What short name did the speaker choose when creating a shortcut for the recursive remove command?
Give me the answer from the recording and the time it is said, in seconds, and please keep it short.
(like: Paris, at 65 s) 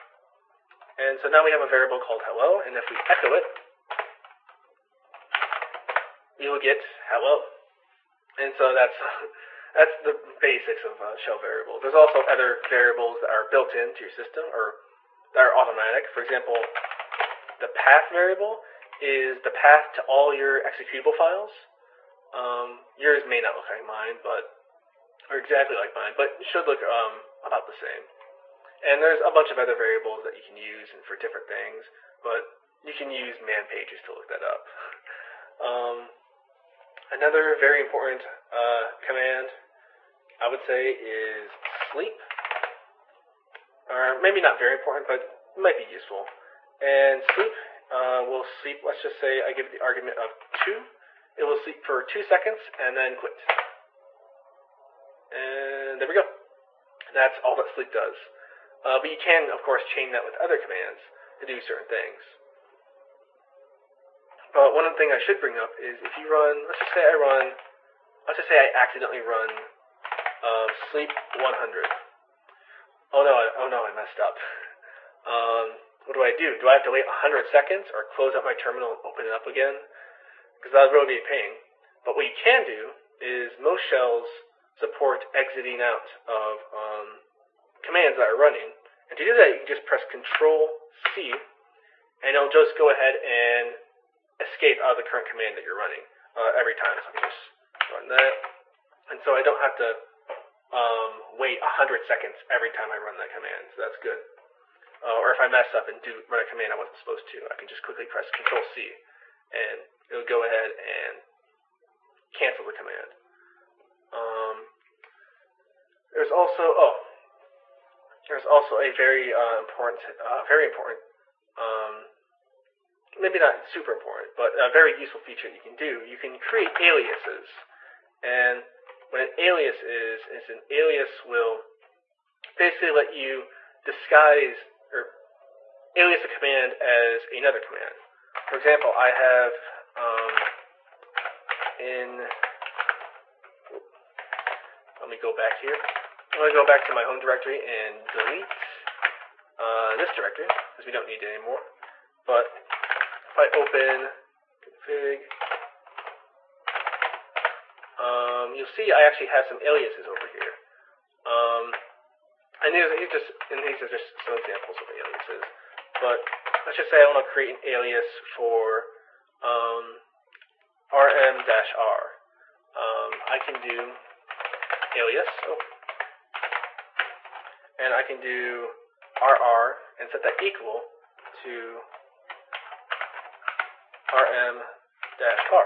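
rr, at 179 s.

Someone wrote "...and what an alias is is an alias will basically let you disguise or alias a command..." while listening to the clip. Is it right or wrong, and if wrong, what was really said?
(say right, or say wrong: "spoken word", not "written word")
right.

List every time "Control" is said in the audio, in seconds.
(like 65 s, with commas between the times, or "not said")
90 s, 108 s.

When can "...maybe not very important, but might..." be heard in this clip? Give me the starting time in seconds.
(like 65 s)
44 s.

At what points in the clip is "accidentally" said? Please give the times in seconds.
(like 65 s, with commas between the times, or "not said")
68 s.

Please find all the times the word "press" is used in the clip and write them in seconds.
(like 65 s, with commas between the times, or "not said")
89 s, 108 s.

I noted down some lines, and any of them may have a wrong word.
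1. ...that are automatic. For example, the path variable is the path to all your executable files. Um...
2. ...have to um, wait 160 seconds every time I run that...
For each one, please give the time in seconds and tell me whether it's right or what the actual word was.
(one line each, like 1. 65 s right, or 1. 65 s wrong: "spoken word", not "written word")
1. 15 s right
2. 99 s wrong: "100", not "160".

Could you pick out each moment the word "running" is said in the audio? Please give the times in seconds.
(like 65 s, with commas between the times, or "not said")
88 s, 95 s.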